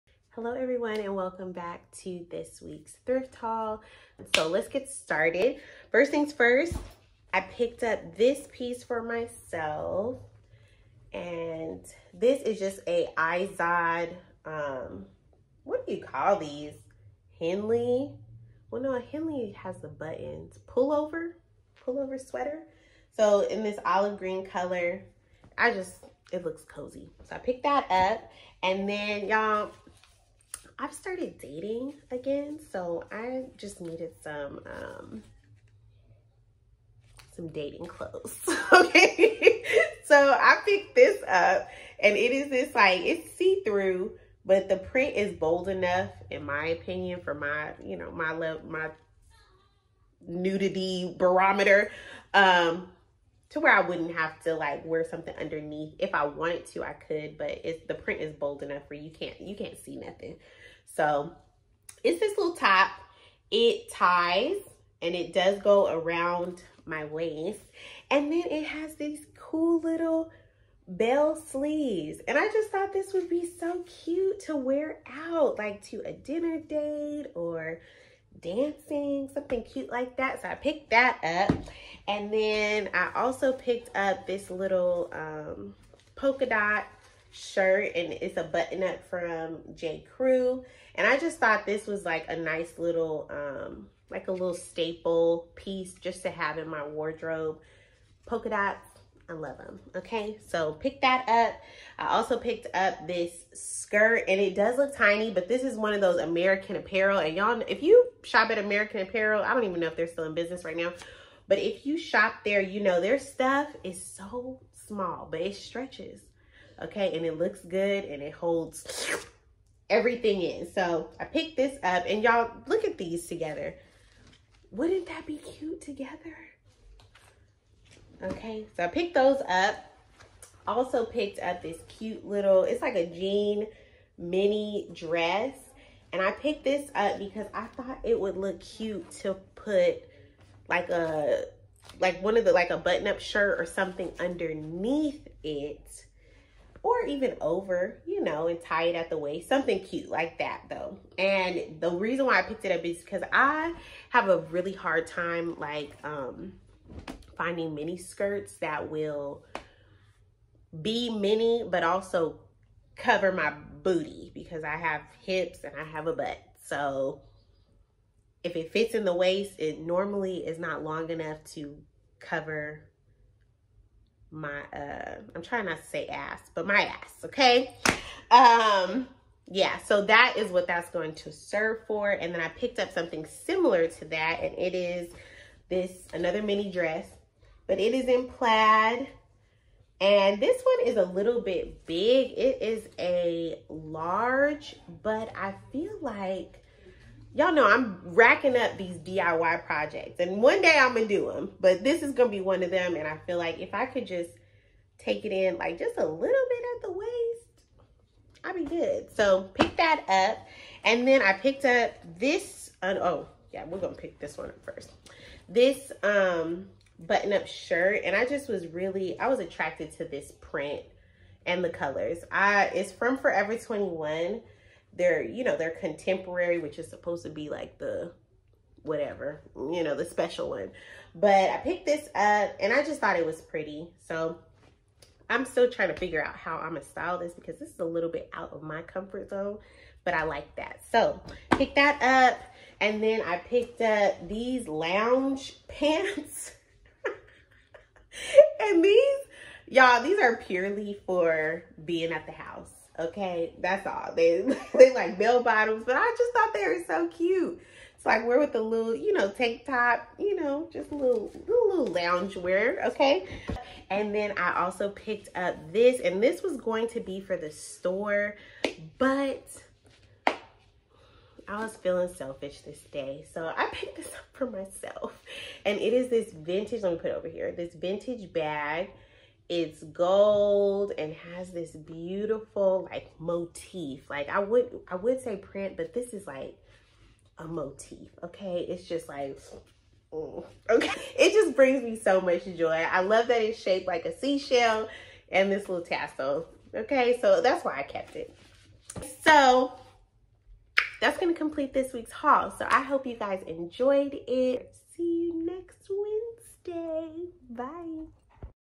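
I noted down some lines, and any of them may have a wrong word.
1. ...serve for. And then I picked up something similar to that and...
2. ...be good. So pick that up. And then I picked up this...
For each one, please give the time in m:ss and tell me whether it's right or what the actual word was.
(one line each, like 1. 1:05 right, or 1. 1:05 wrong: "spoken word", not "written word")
1. 3:01 right
2. 3:28 right.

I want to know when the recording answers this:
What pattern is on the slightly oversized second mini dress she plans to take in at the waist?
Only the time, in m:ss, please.
3:08.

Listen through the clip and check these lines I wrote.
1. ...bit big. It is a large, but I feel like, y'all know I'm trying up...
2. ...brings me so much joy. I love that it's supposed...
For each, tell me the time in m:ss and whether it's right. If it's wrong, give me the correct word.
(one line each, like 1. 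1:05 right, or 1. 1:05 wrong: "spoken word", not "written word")
1. 3:11 wrong: "racking", not "trying"
2. 4:51 wrong: "shaped", not "supposed".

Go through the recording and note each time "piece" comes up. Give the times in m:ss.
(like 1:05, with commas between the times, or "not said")
0:08, 1:35.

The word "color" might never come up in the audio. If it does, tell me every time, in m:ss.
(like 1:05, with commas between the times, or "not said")
0:24, 3:41.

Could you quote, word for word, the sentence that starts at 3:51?
But I picked this up and I just thought it was pretty.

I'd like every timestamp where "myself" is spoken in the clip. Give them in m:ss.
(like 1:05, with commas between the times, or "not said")
0:09, 4:34.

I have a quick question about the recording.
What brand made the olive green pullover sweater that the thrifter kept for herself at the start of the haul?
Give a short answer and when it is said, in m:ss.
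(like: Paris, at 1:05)
Izod, at 0:13.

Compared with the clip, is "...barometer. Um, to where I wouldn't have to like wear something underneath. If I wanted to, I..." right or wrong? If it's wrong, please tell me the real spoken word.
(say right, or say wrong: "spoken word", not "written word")
right.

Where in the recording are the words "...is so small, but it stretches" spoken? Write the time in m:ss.
1:53.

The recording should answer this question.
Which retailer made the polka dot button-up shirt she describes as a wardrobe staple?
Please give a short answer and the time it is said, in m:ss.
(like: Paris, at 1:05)
J. Crew, at 1:29.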